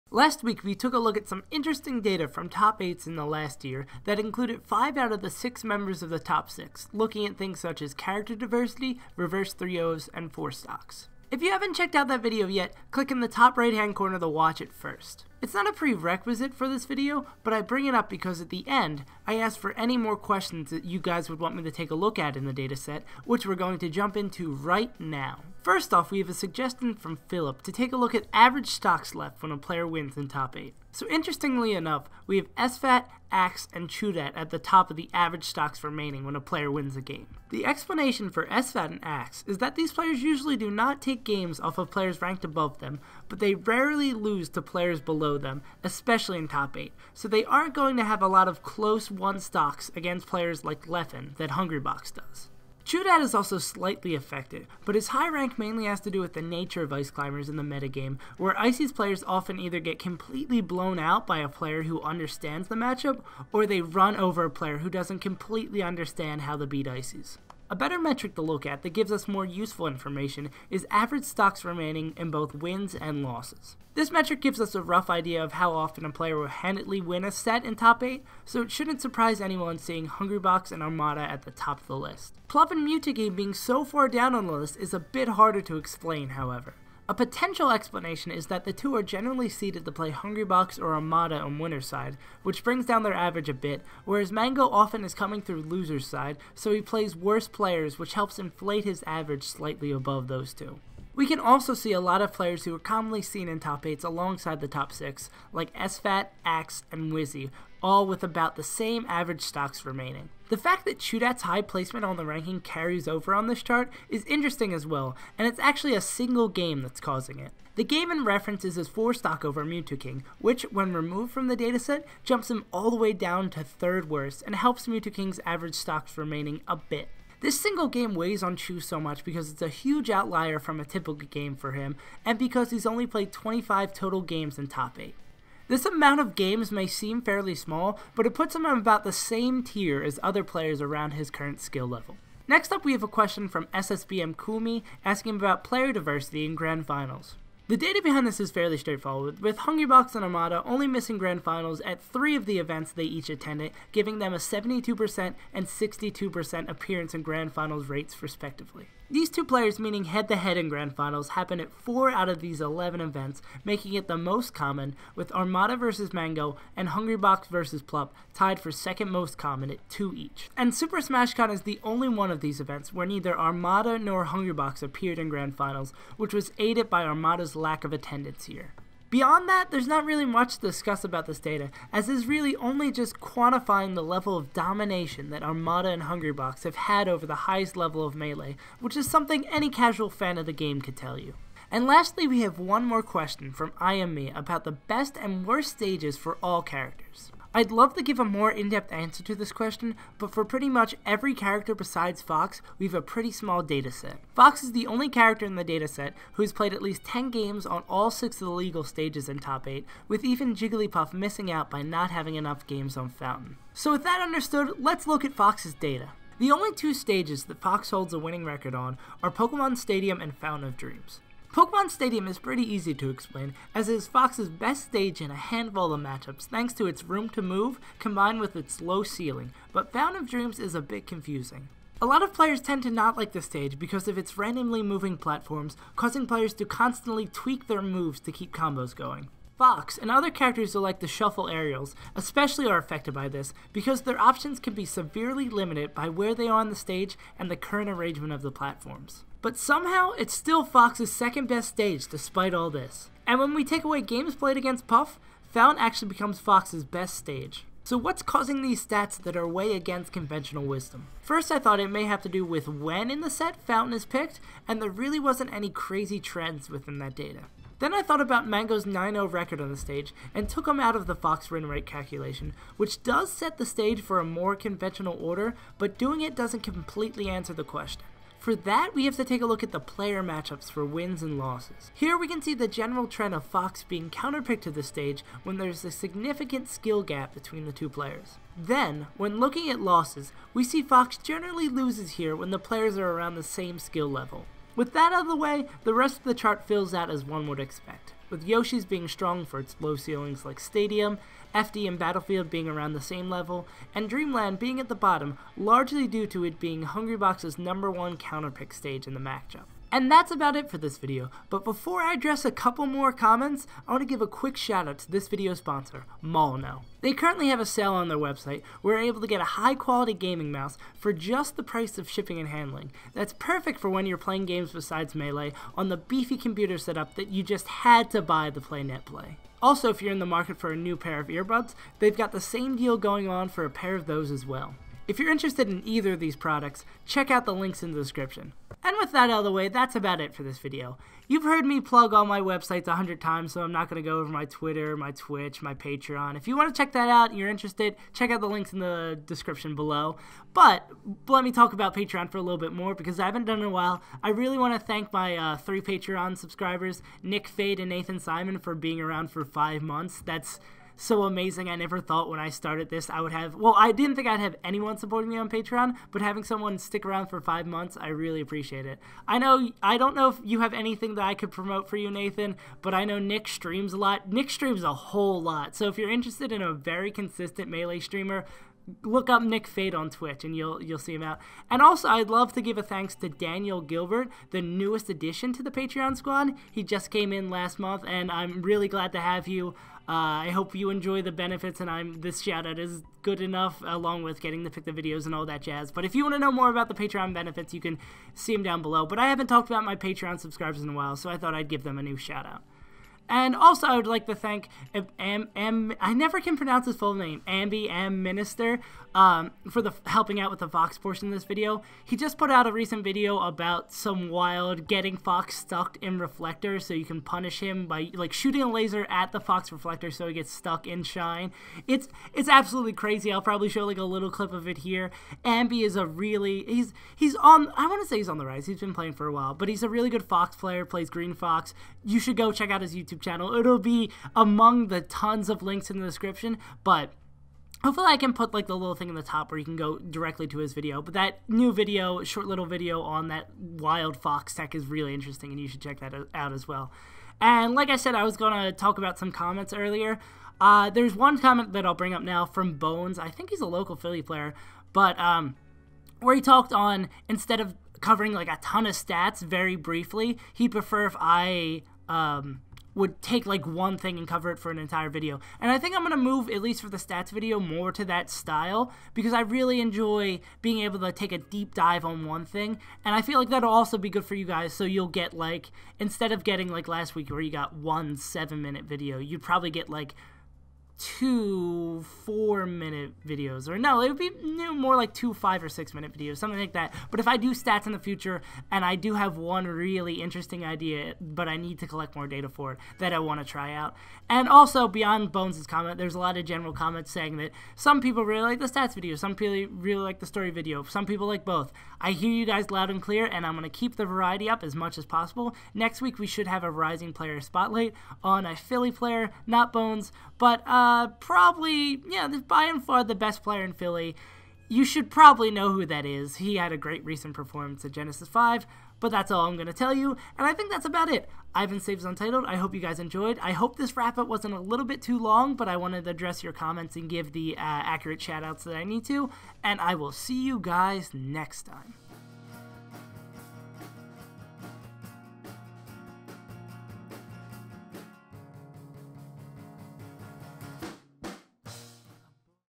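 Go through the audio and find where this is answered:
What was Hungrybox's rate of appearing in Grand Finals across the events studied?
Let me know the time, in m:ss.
2:34.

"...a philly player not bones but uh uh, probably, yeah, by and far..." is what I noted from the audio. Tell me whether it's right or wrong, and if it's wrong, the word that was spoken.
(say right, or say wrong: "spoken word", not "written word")
right.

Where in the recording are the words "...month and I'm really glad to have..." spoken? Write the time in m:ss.
6:27.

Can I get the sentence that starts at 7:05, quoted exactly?
Ambi is a really he's he's on I want to say he's on the rise.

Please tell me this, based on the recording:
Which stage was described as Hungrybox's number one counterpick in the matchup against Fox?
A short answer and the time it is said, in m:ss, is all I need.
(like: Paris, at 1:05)
Dreamland, at 5:04.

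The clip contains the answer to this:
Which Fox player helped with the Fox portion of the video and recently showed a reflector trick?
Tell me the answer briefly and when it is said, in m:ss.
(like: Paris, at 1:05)
Ambisinister, at 6:47.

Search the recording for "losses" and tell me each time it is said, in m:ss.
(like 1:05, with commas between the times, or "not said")
1:13, 4:41, 4:49.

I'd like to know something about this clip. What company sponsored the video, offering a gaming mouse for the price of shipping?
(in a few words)
Molino.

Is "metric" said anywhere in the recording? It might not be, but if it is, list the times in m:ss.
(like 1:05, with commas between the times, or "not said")
1:07, 1:14.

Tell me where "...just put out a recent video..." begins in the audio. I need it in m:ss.
6:52.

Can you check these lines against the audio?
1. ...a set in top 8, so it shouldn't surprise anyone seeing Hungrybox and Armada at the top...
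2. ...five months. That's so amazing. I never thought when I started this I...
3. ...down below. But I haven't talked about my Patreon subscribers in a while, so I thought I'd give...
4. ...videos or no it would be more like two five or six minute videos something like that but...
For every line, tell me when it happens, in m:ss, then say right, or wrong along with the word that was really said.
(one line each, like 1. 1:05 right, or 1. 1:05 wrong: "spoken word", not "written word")
1. 1:17 right
2. 5:59 right
3. 6:38 right
4. 8:03 right.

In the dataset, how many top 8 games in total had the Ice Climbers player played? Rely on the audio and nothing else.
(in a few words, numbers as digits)
25.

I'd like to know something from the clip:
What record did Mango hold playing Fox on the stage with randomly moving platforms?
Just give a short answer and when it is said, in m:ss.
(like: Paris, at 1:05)
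9-0, at 4:28.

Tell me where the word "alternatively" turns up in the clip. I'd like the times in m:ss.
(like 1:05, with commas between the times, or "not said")
not said.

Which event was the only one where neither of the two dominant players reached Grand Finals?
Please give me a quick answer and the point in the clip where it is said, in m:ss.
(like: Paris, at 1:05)
Super Smash Con, at 2:50.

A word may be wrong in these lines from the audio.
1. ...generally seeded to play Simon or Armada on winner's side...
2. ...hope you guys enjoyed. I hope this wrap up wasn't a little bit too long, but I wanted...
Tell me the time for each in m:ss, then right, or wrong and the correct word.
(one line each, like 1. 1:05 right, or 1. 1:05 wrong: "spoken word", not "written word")
1. 1:29 wrong: "Hungrybox", not "Simon"
2. 8:42 right.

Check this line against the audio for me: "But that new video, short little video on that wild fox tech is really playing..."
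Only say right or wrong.
wrong.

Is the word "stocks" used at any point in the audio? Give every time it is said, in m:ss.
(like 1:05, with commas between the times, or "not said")
0:10, 0:28, 0:35, 0:49, 1:11, 1:49, 1:59, 2:05.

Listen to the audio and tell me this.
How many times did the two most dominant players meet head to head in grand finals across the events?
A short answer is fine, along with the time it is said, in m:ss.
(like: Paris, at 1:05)
4, at 2:41.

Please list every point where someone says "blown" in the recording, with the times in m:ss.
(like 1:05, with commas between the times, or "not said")
1:00.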